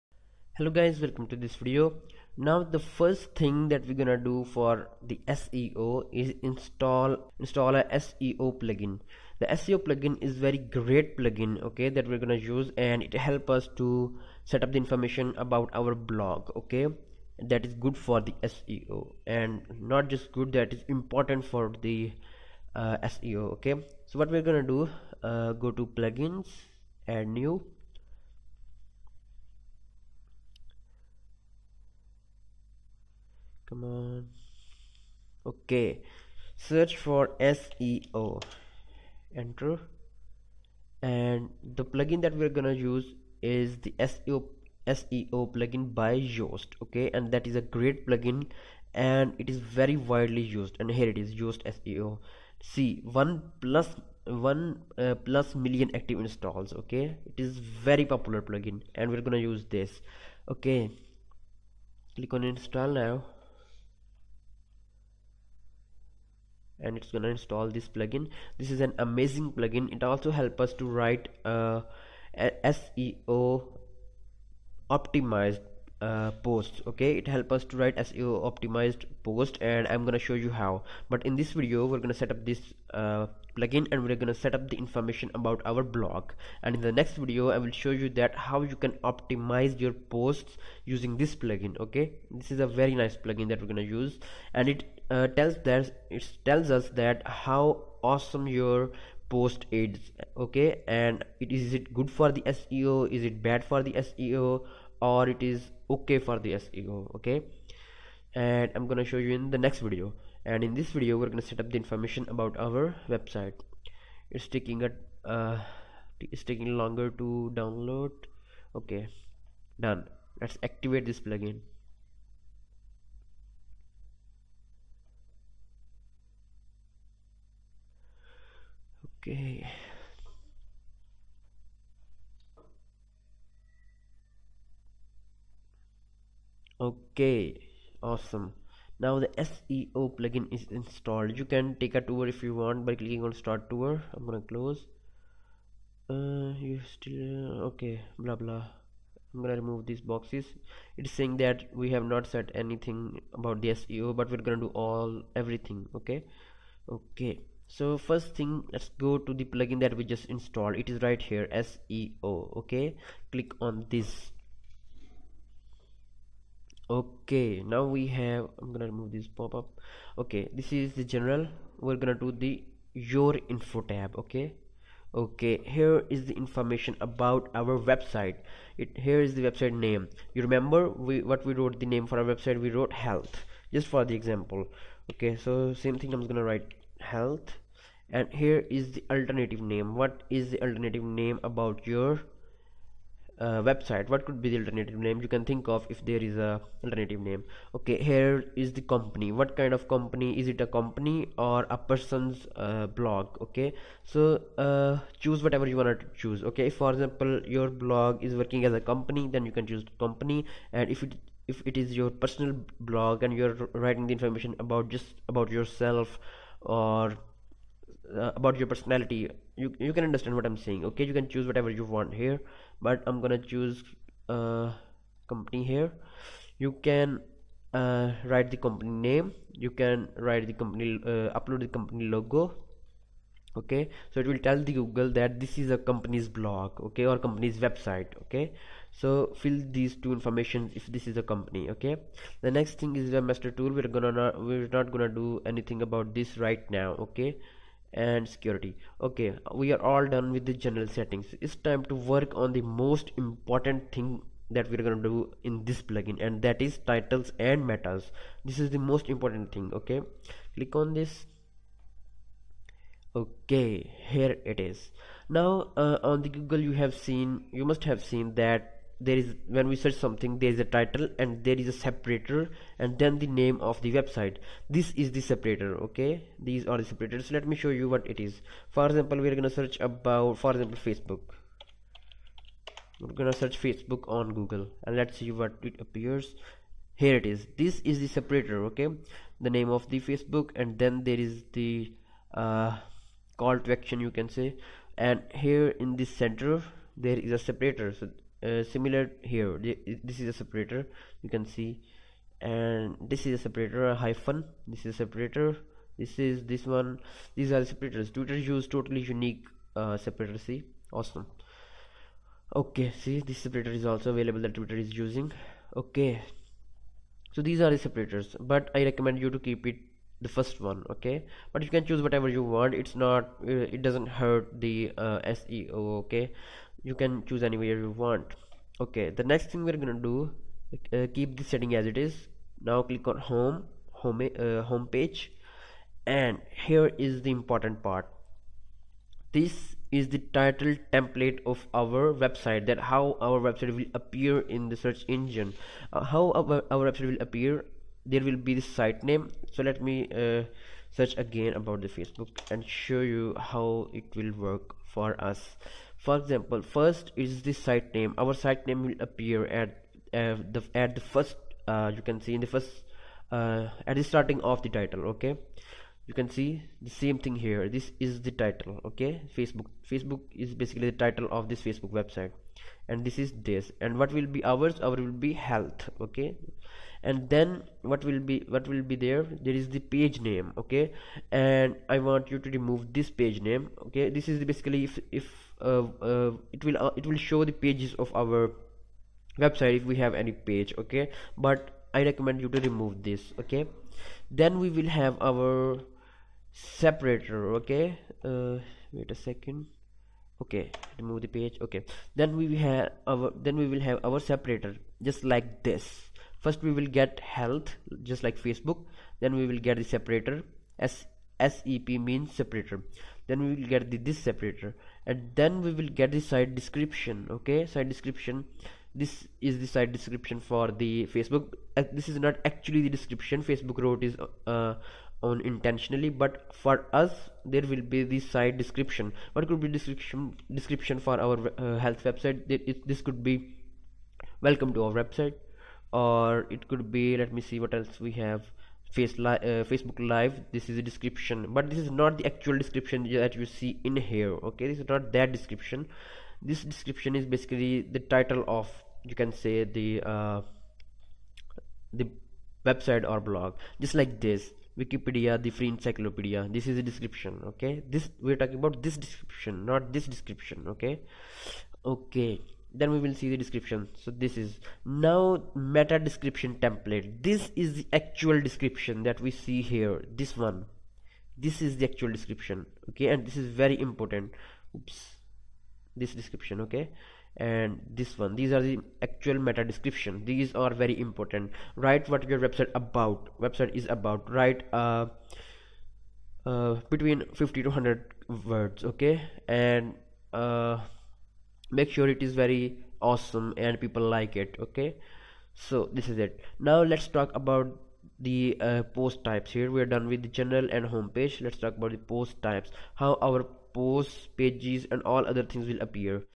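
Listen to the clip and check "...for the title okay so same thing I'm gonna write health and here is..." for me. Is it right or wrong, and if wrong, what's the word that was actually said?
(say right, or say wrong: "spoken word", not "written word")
wrong: "example", not "title".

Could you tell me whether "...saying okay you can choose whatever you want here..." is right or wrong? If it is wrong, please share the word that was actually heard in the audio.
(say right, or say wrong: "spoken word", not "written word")
right.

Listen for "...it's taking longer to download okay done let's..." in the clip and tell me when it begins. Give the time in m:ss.
1:56.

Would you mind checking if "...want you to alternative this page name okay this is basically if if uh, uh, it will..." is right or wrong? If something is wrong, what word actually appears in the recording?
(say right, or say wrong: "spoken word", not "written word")
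wrong: "remove", not "alternative".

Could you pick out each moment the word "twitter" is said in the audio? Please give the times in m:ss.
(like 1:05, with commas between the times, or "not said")
5:08, 5:14.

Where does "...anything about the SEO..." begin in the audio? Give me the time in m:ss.
2:32.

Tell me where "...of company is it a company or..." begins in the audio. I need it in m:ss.
3:19.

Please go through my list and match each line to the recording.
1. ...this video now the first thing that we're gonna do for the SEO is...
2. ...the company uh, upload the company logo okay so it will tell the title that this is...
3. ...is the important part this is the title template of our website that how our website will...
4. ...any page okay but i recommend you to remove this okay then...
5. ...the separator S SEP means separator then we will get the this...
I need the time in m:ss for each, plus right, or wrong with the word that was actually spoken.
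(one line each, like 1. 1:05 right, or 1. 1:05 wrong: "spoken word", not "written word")
1. 0:01 right
2. 3:50 wrong: "google", not "title"
3. 5:37 right
4. 6:30 right
5. 6:49 right.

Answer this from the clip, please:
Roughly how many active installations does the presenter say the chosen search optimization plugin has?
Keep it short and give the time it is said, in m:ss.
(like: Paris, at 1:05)
1 million, at 0:53.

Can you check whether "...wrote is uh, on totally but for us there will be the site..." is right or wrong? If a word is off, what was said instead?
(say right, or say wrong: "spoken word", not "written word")
wrong: "intentionally", not "totally".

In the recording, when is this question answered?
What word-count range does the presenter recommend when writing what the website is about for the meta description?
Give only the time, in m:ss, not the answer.
8:06.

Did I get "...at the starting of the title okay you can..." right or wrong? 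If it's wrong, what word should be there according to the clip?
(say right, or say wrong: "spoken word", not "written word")
right.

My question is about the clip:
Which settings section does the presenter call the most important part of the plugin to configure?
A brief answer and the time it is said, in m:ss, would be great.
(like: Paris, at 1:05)
Titles and metas, at 4:16.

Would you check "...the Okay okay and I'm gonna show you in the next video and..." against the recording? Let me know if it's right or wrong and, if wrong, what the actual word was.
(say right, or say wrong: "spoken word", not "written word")
wrong: "SEO", not "Okay".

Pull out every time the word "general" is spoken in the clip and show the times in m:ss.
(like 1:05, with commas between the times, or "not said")
2:51, 4:10, 8:20.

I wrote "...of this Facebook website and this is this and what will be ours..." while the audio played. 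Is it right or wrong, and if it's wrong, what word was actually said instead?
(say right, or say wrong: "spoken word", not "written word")
right.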